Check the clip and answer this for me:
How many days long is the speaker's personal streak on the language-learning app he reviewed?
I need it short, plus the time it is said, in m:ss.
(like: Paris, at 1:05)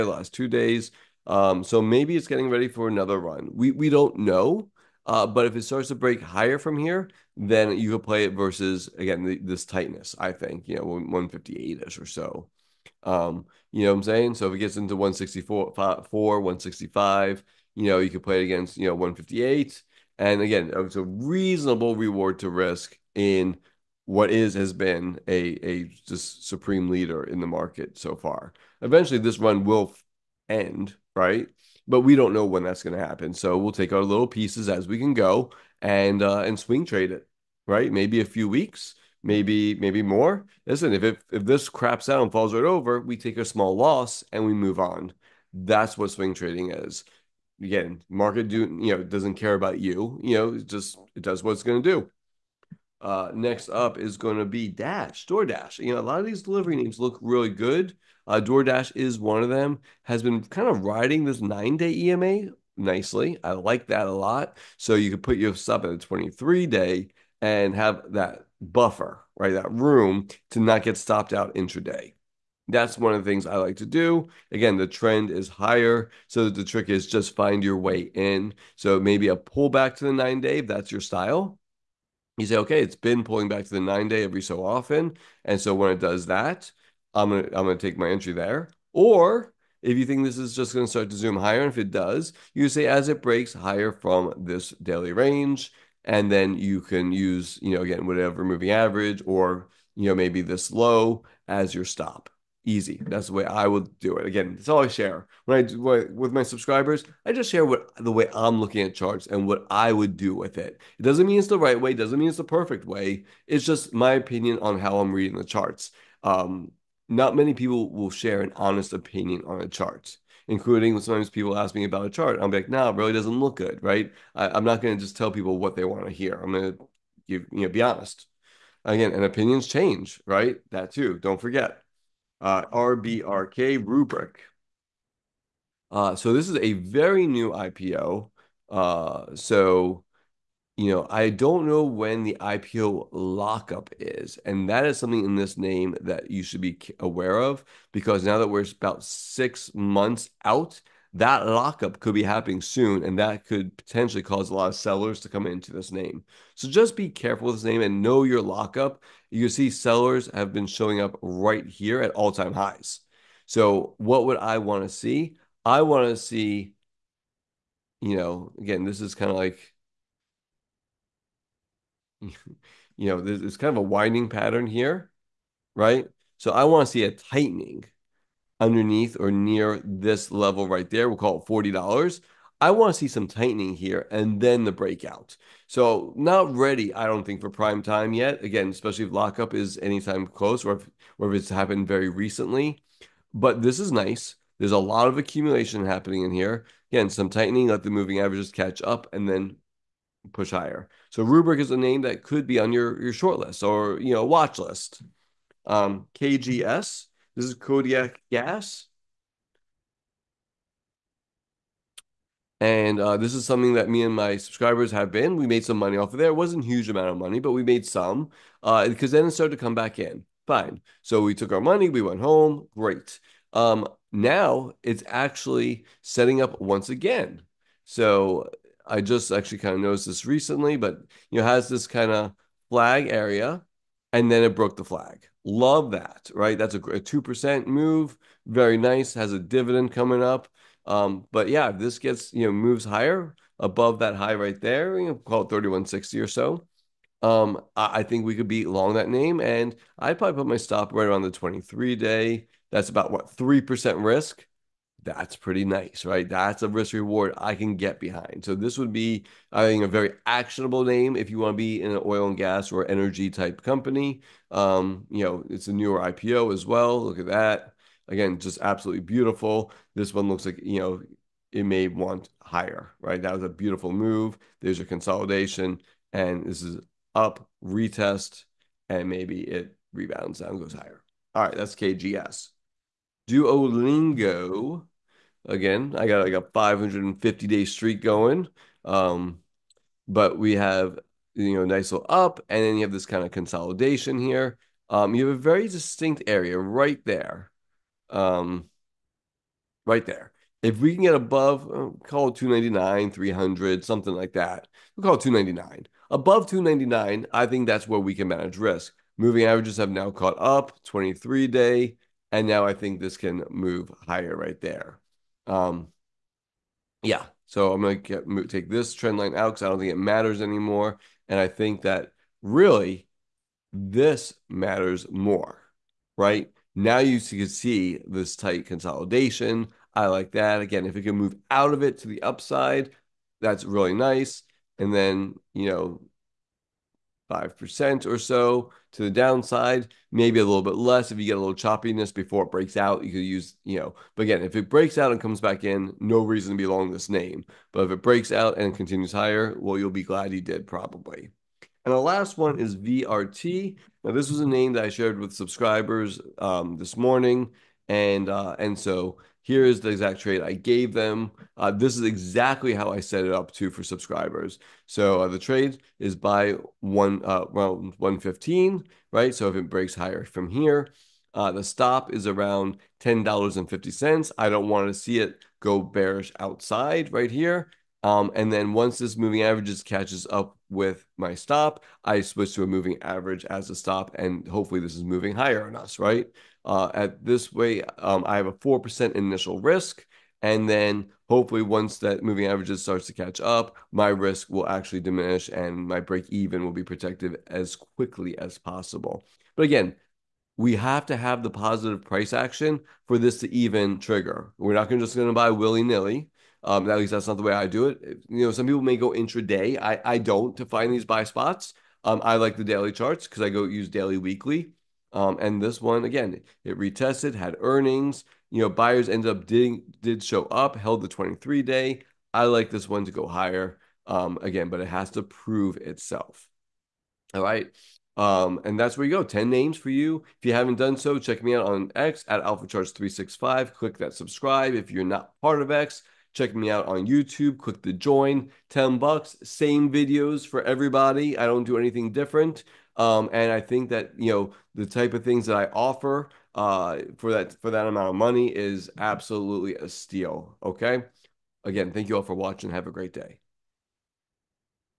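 550, at 4:46.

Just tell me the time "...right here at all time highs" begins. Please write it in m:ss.
2:41.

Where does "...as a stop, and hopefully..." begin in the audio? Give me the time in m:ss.
6:23.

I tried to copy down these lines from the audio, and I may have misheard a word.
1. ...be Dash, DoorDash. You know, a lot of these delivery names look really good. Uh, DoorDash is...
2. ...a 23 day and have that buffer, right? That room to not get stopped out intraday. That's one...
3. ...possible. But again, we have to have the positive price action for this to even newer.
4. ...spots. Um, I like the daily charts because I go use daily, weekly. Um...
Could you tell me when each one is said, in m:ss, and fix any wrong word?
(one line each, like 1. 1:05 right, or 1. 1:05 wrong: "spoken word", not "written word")
1. 0:54 right
2. 1:05 right
3. 6:38 wrong: "trigger", not "newer"
4. 6:51 right.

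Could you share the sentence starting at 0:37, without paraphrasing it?
Maybe a few weeks, maybe maybe more.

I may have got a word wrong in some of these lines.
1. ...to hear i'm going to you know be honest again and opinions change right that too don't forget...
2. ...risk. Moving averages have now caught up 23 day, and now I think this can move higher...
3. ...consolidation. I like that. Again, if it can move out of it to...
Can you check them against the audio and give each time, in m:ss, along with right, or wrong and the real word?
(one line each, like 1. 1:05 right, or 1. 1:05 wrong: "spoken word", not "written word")
1. 2:06 right
2. 5:08 right
3. 5:28 right.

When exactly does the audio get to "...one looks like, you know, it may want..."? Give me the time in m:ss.
4:30.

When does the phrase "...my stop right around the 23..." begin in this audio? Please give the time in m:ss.
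4:10.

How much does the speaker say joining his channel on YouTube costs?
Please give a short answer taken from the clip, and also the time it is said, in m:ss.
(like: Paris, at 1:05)
10 bucks, at 7:18.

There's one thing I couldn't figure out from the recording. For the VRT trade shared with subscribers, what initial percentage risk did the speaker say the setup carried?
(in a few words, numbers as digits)
4%.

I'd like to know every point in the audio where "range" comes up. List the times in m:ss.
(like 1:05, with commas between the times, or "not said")
1:35.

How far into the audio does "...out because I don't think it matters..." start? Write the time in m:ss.
5:19.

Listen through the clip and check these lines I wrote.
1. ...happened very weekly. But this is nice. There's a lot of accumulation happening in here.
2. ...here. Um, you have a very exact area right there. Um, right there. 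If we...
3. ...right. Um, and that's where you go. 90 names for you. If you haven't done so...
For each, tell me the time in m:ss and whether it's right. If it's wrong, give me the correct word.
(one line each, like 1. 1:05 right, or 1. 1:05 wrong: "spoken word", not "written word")
1. 3:11 wrong: "recently", not "weekly"
2. 4:54 wrong: "distinct", not "exact"
3. 7:07 wrong: "10", not "90".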